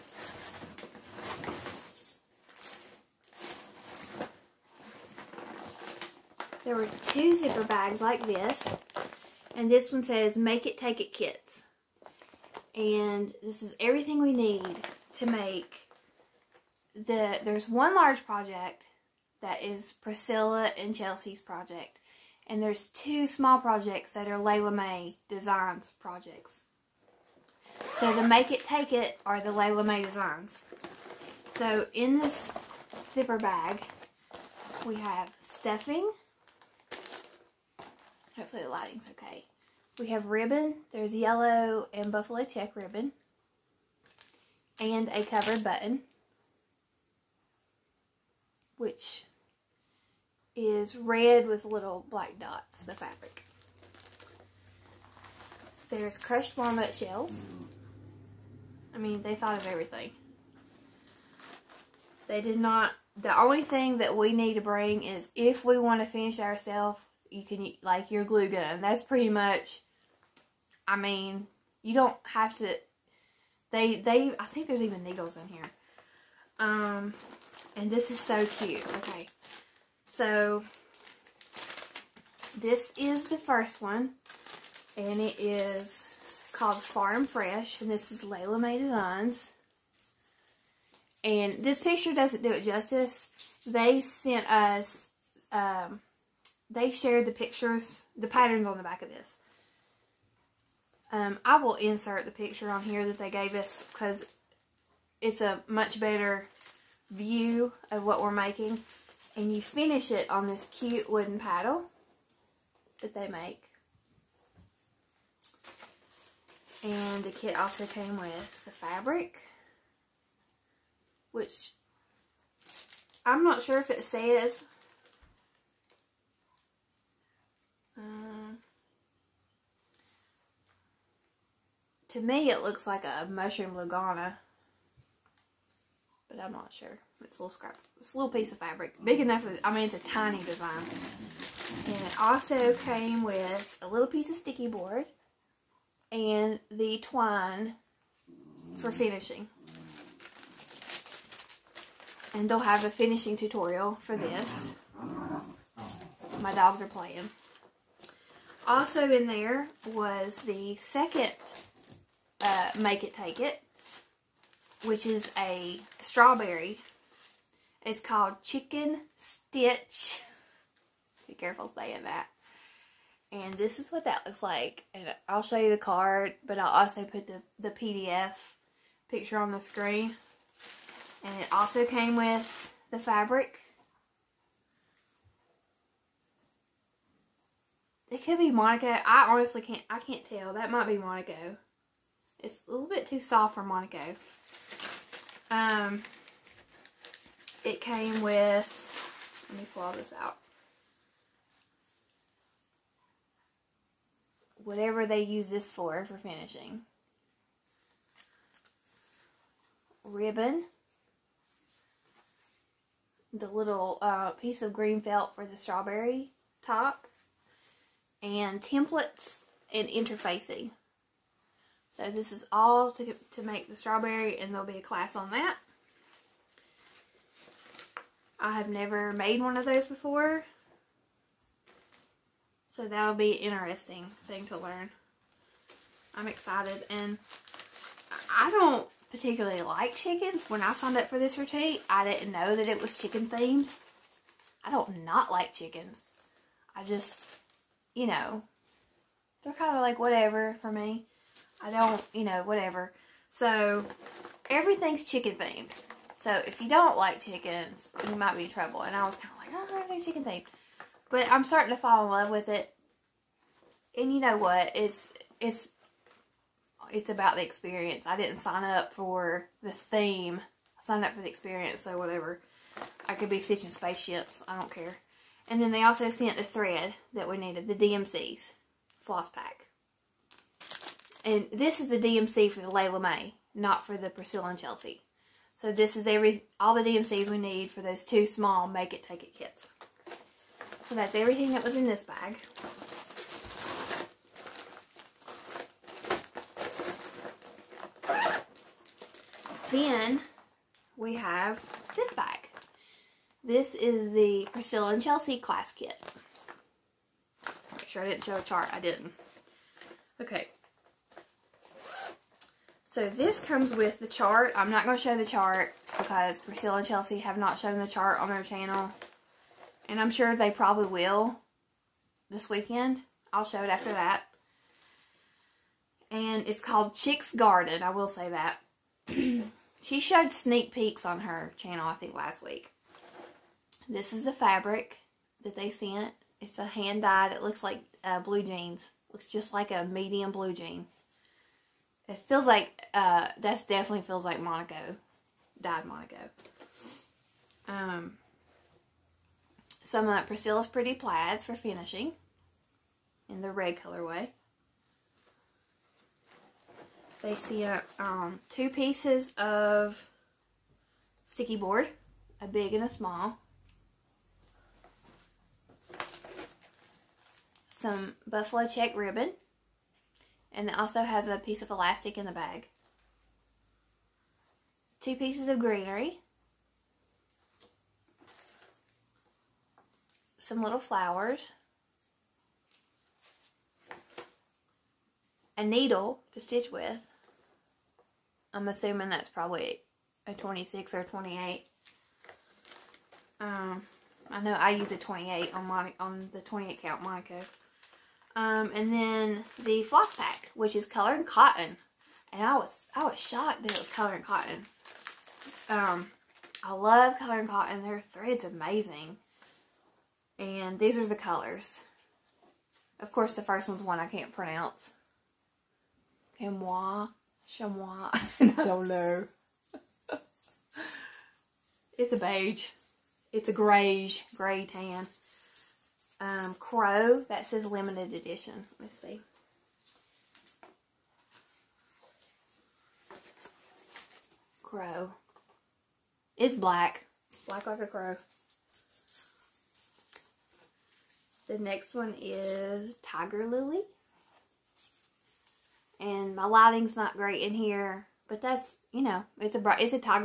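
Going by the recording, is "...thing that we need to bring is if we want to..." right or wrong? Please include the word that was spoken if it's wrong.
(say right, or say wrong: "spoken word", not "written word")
right.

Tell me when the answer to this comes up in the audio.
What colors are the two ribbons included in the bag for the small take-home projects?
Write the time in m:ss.
0:41.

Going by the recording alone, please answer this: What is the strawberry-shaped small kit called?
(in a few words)
Chicken Stitch.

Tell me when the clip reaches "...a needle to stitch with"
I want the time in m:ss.
6:25.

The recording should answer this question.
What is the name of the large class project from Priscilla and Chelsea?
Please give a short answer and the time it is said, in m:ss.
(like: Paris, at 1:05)
Chick's Garden, at 5:26.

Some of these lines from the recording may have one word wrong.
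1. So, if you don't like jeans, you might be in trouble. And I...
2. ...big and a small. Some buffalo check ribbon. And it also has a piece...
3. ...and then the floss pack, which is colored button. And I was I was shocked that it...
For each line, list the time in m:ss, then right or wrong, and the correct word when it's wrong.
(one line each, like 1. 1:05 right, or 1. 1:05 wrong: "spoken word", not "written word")
1. 4:16 wrong: "chickens", not "jeans"
2. 6:02 right
3. 6:38 wrong: "cotton", not "button".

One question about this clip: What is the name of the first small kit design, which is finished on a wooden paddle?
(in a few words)
Farm Fresh.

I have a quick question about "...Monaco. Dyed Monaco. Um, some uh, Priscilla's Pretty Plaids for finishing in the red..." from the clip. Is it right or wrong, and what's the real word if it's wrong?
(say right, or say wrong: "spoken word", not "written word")
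right.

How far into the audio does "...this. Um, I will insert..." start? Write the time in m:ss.
1:39.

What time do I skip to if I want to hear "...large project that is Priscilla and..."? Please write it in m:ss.
0:17.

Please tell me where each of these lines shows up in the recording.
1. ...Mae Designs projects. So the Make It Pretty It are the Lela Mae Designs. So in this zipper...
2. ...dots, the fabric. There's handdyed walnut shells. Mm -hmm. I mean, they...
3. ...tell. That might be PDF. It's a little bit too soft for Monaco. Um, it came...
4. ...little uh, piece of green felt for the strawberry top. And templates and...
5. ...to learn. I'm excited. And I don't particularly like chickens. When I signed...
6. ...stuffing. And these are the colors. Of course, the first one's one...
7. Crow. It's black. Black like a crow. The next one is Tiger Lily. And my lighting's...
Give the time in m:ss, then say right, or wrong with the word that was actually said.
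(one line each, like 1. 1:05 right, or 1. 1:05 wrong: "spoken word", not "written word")
1. 0:24 wrong: "Take", not "Pretty"
2. 0:52 wrong: "crushed", not "handdyed"
3. 3:10 wrong: "Monaco", not "PDF"
4. 3:33 right
5. 3:54 right
6. 6:48 wrong: "amazing", not "stuffing"
7. 7:14 right.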